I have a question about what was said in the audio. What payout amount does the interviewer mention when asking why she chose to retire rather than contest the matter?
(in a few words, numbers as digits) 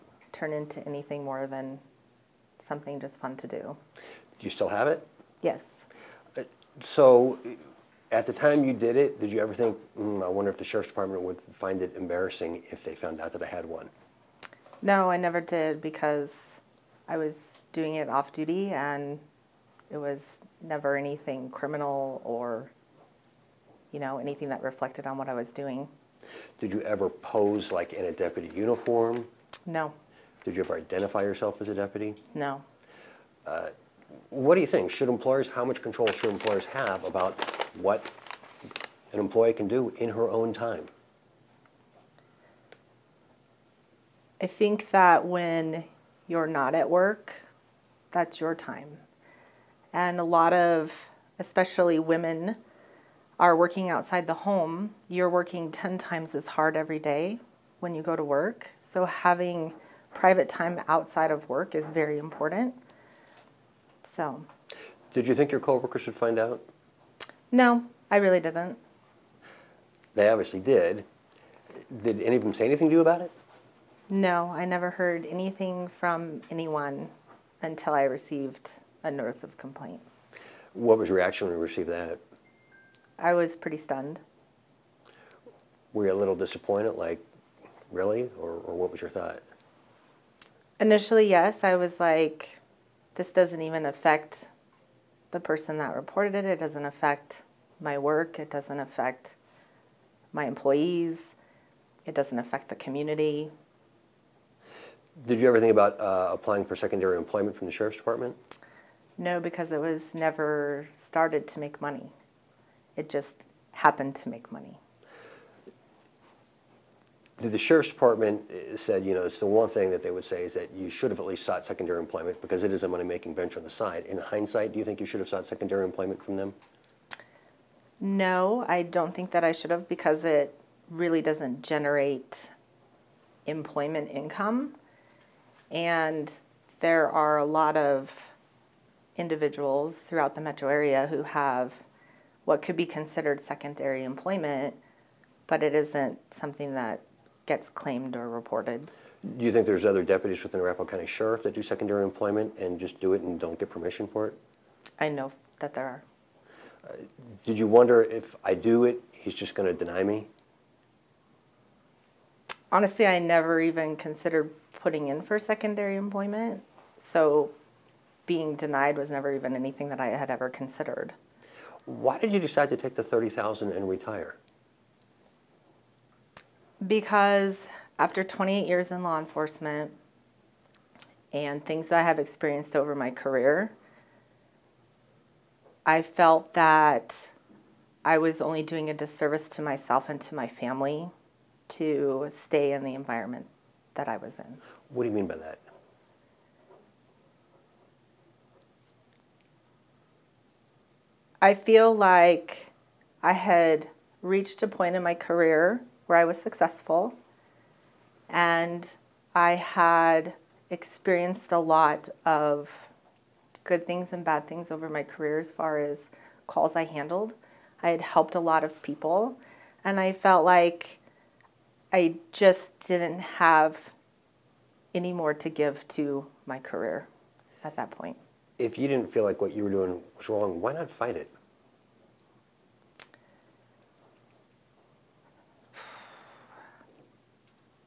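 $30,000.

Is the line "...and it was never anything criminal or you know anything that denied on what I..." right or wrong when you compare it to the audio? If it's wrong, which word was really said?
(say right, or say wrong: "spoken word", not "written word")
wrong: "reflected", not "denied".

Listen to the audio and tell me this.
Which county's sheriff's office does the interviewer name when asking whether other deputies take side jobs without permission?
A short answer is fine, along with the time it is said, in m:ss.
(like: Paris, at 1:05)
Arapahoe County, at 2:30.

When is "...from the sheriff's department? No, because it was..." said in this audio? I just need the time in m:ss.
1:47.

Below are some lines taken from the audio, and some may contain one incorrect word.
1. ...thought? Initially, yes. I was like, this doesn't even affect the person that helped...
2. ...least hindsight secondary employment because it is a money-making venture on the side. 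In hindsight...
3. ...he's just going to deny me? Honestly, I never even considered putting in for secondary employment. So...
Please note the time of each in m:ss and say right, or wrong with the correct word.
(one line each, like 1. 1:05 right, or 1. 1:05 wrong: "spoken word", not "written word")
1. 1:29 wrong: "reported", not "helped"
2. 2:01 wrong: "sought", not "hindsight"
3. 2:39 right.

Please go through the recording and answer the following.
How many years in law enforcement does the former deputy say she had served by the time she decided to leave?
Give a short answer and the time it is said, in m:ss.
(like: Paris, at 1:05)
28, at 2:58.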